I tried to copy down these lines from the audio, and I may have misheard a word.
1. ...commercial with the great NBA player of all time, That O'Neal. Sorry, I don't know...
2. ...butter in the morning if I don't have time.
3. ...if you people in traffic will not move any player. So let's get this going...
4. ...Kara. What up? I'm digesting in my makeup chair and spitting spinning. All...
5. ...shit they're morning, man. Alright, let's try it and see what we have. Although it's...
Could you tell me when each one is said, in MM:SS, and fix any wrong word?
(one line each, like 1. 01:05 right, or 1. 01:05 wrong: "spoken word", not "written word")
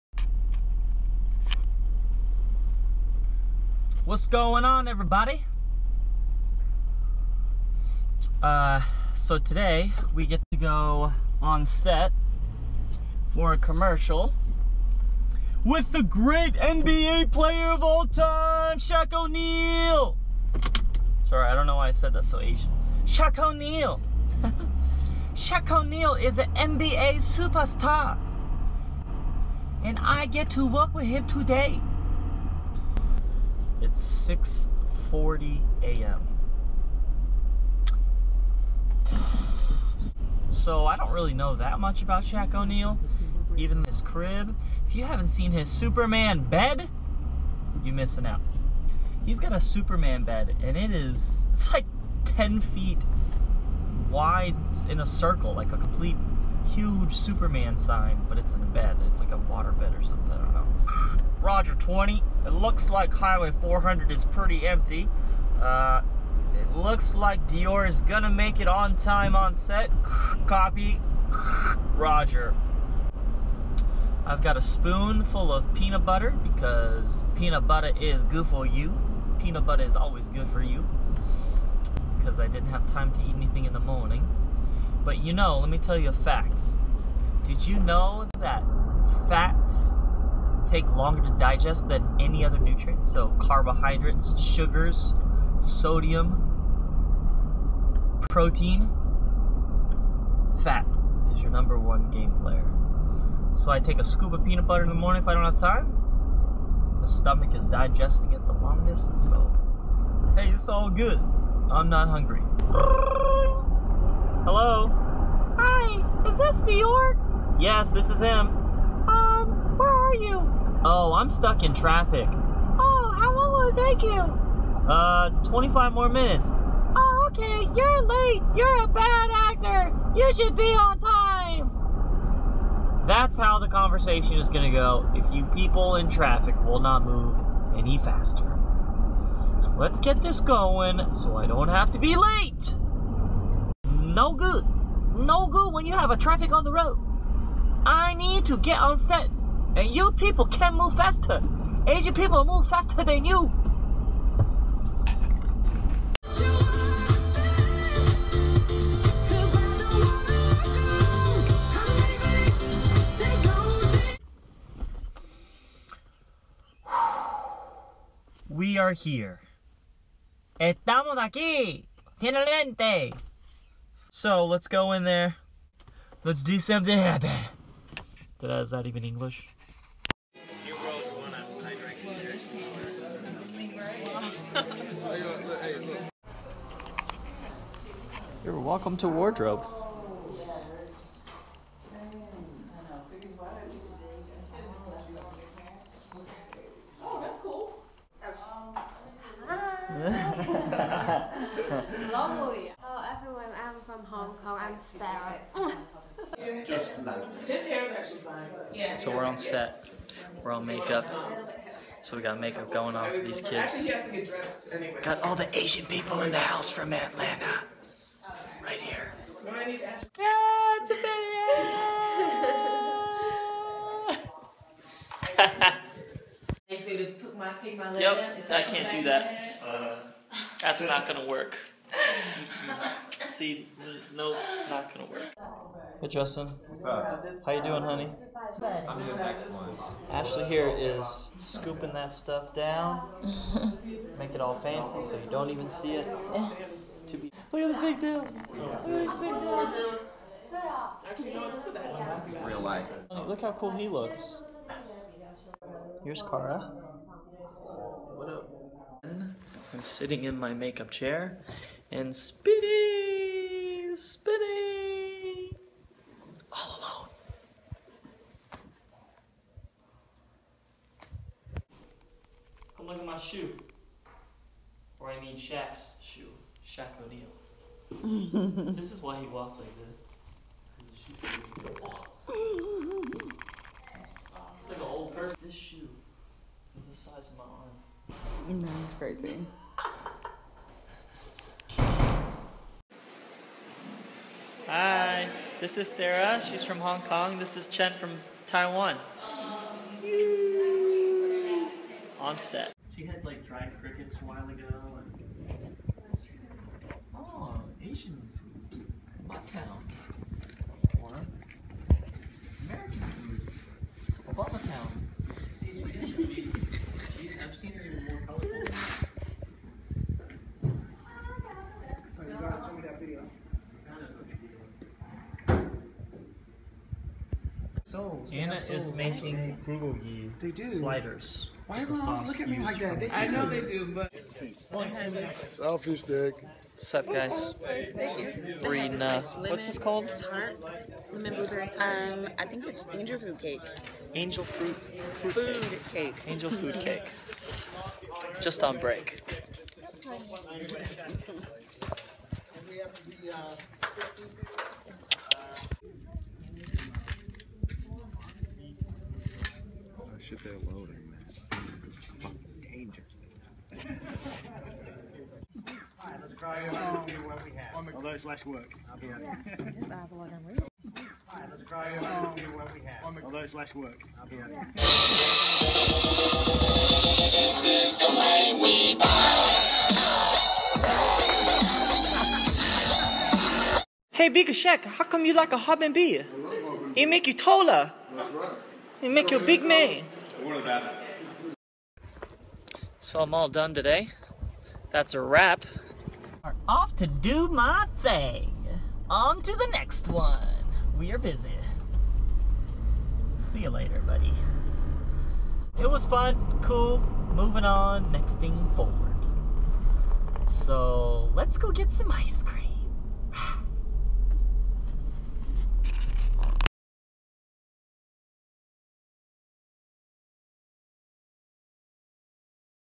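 1. 00:13 wrong: "Shaq", not "That"
2. 01:44 right
3. 02:15 wrong: "faster", not "player"
4. 04:16 wrong: "sitting", not "digesting"
5. 06:00 wrong: "loading", not "morning".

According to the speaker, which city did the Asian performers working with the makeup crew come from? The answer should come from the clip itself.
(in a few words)
Atlanta.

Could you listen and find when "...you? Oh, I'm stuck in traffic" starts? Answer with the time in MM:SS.
02:00.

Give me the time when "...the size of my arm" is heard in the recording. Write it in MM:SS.
04:46.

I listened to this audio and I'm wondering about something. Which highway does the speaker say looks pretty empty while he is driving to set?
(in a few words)
Highway 400.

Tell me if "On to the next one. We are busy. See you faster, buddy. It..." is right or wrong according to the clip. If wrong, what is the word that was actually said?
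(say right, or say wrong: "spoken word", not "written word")
wrong: "later", not "faster".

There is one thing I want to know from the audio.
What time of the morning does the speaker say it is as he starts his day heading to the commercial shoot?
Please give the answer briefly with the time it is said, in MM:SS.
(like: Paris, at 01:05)
6:40 a.m., at 00:34.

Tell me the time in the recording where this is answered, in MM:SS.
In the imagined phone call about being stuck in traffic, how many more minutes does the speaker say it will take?
02:05.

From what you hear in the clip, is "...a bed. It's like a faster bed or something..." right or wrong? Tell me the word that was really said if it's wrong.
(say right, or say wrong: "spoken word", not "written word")
wrong: "water", not "faster".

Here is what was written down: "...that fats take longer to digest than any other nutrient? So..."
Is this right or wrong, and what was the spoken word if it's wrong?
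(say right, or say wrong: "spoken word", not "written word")
right.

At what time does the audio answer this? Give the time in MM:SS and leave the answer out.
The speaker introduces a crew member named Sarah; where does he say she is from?
04:56.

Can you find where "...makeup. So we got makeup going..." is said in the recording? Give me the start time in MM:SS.
03:30.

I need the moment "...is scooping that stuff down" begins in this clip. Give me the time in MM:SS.
04:00.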